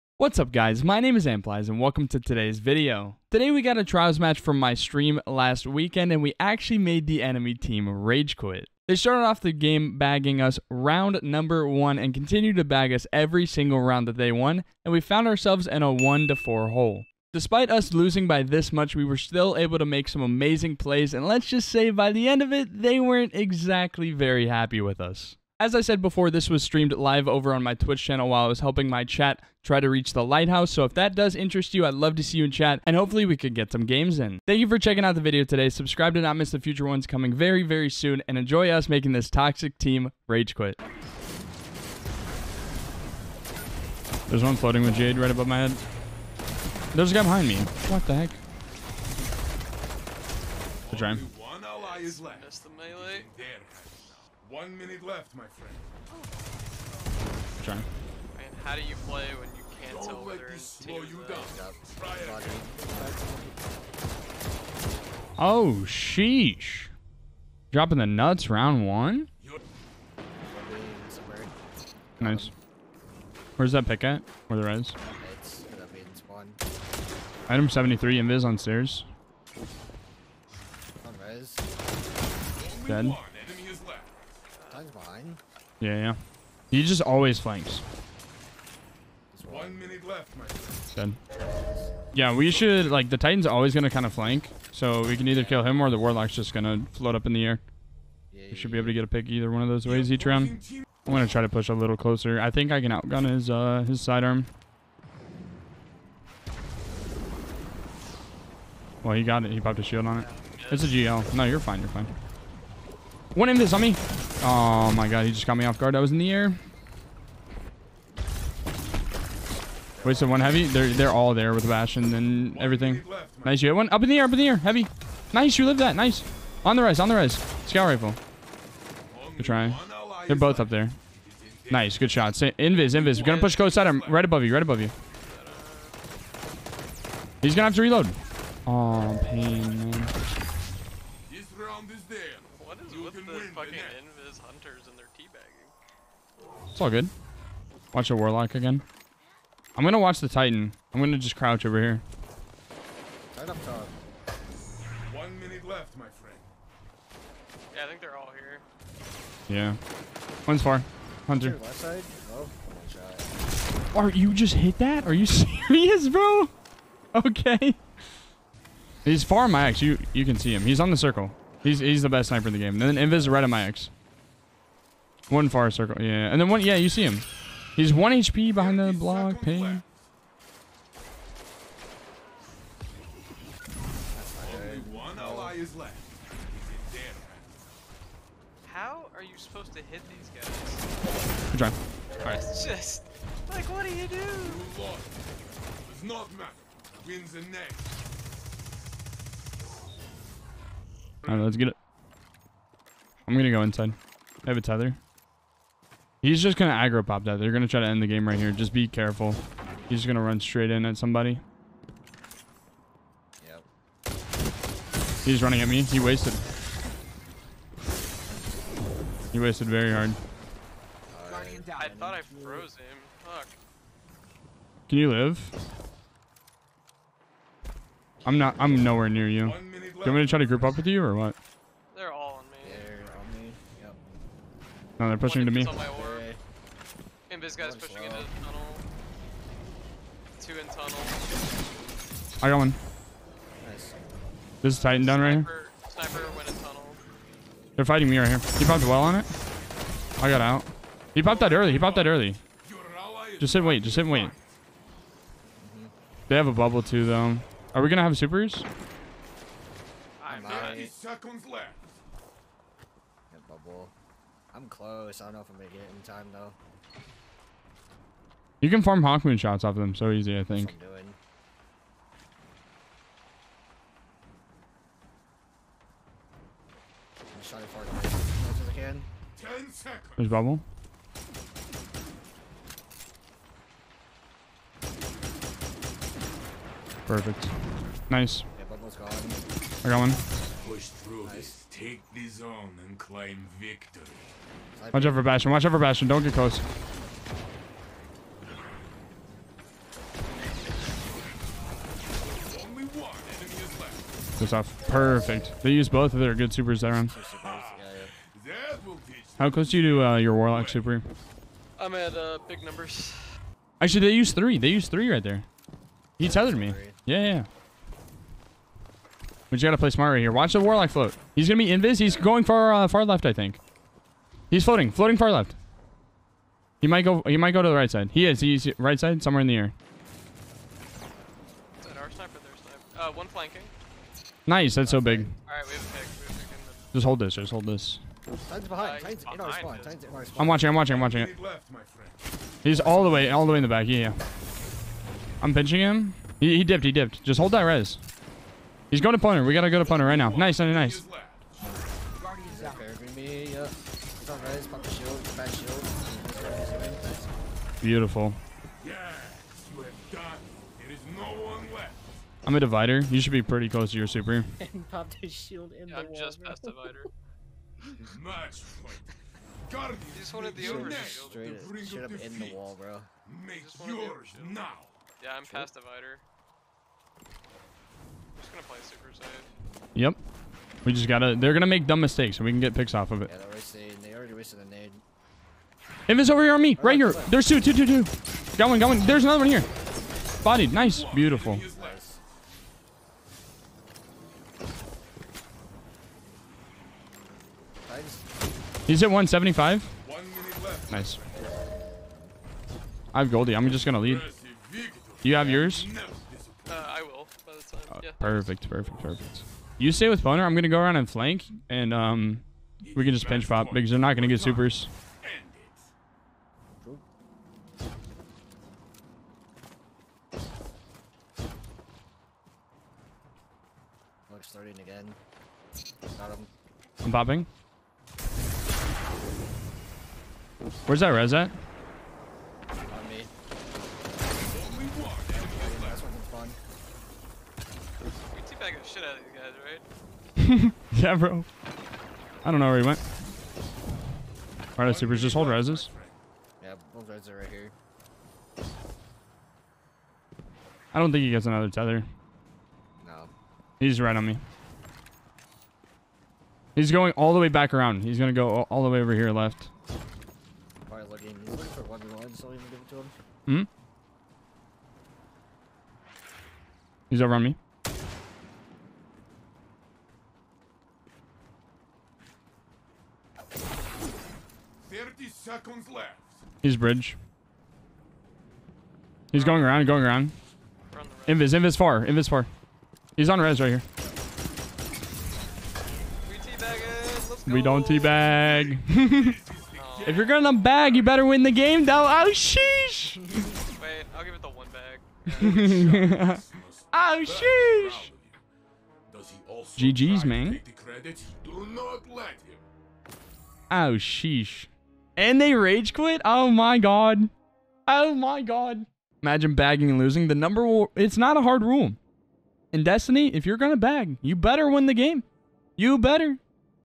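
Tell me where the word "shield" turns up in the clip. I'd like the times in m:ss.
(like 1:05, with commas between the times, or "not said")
1:49, 6:05, 6:10.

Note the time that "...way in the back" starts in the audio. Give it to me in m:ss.
5:43.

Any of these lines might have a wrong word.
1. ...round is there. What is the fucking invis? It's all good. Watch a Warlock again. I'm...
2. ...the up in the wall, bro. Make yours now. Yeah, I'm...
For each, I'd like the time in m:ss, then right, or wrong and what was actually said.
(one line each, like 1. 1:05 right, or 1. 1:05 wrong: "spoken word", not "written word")
1. 2:21 right
2. 6:11 right.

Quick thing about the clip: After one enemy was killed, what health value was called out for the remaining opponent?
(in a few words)
175.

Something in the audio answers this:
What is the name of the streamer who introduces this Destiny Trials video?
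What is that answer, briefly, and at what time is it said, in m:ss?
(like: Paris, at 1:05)
Amplies, at 0:01.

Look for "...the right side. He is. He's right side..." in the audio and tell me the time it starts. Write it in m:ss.
5:27.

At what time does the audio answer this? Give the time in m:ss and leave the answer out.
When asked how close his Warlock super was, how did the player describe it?
5:12.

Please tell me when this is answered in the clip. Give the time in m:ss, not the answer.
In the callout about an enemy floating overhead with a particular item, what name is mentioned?
0:44.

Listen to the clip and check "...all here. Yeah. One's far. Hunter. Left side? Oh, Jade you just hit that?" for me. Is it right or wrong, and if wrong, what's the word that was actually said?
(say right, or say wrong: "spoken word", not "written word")
wrong: "Are", not "Jade".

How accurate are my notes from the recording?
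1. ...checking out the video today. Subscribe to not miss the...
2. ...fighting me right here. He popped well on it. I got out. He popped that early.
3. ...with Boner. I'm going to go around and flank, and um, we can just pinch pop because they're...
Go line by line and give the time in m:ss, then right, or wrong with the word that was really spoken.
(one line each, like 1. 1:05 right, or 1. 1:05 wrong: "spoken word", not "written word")
1. 0:34 right
2. 4:07 right
3. 6:50 right.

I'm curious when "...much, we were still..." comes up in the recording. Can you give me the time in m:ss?
0:18.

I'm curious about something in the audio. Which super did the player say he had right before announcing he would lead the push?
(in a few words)
Goldie.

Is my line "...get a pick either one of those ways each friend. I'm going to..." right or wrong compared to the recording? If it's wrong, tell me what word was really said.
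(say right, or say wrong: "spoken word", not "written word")
wrong: "round", not "friend".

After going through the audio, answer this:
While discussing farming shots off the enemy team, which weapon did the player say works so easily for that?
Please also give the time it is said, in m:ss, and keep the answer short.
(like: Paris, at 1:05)
Hawkmoon, at 4:29.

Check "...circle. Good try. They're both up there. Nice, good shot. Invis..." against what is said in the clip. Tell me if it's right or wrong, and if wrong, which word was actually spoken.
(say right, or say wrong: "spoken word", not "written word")
wrong: "rifle", not "circle".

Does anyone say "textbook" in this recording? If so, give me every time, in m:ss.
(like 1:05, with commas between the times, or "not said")
not said.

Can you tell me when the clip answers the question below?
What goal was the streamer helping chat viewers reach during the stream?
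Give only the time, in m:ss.
0:30.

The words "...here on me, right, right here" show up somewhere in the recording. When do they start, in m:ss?
6:26.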